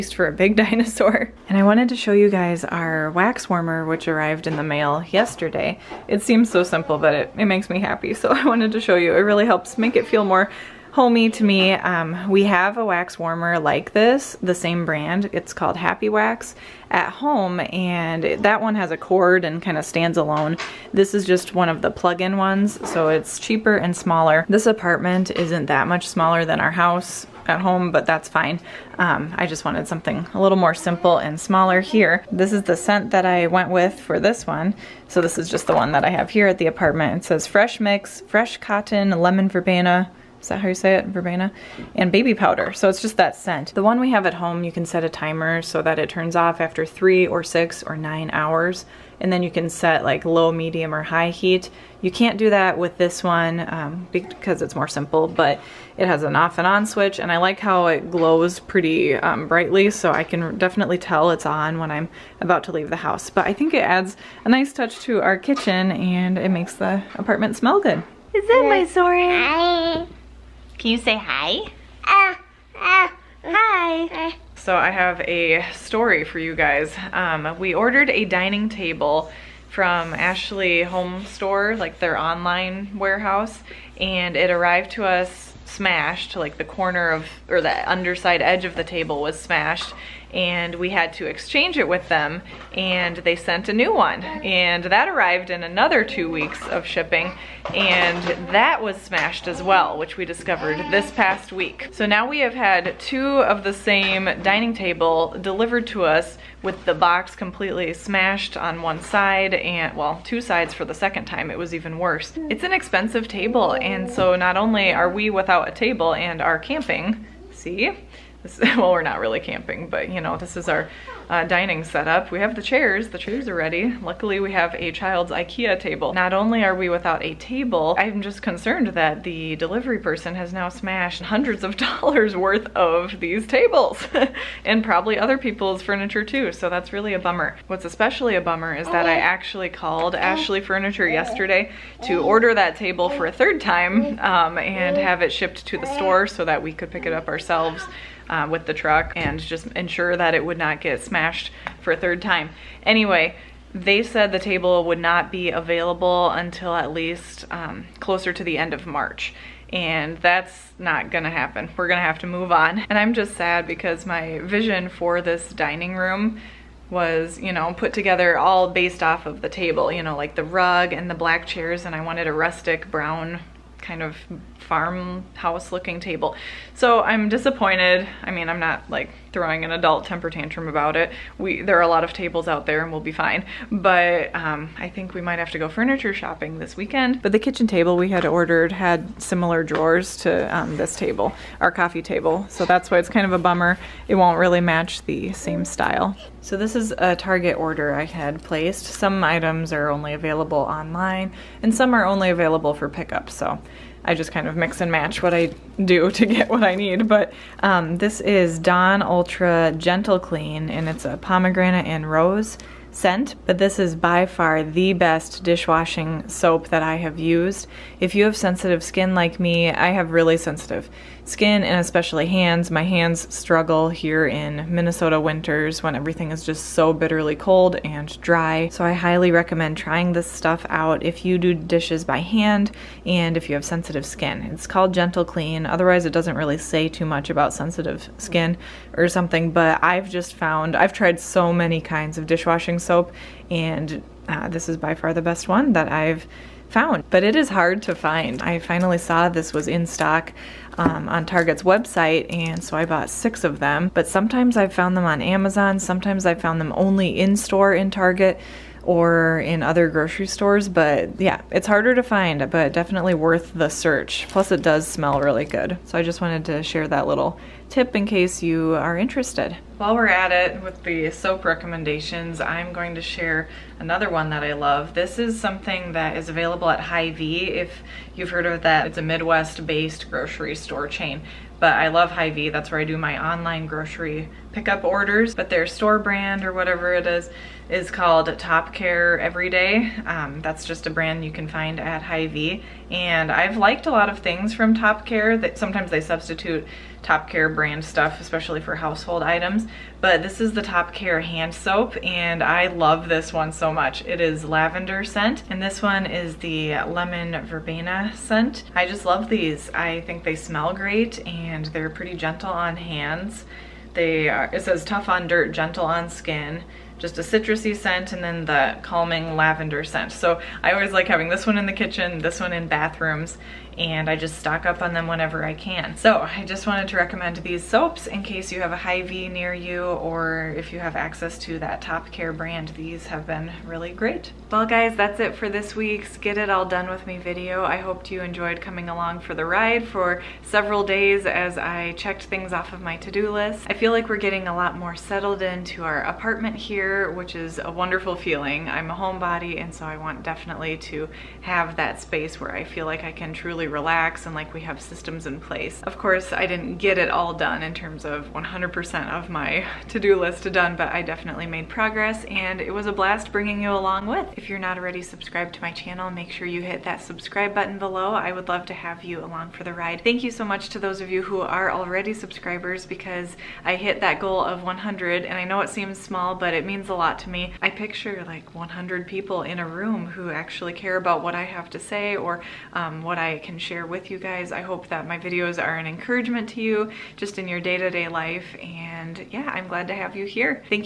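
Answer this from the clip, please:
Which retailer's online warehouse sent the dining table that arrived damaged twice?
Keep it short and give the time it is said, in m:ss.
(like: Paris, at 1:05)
Ashley Home Store, at 1:20.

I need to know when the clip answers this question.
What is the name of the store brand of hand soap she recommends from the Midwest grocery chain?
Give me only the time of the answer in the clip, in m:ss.
4:48.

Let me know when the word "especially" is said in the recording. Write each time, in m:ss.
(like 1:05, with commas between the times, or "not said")
2:17, 3:41, 4:58.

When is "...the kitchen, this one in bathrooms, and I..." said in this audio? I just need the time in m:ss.
5:21.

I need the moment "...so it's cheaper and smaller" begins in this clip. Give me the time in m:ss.
0:22.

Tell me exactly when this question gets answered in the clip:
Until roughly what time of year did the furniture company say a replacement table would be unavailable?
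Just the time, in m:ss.
2:38.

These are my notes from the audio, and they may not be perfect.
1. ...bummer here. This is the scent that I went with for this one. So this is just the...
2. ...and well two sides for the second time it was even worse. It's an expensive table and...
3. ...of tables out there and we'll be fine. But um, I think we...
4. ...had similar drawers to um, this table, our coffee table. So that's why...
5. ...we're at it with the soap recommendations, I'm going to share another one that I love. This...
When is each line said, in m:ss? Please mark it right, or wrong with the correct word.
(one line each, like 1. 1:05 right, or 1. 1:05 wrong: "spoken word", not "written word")
1. 0:31 wrong: "smaller", not "bummer"
2. 1:49 right
3. 3:02 right
4. 3:08 right
5. 4:29 right.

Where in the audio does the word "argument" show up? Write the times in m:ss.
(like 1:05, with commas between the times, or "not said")
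not said.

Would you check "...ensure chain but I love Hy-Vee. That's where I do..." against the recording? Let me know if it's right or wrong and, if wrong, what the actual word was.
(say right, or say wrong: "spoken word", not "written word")
wrong: "store", not "ensure".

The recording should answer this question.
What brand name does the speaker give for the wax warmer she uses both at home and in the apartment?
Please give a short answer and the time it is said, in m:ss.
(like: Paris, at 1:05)
Happy Wax, at 0:15.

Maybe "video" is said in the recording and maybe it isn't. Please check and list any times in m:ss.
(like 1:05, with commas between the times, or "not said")
5:37, 6:25.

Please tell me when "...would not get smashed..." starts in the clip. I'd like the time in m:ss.
2:30.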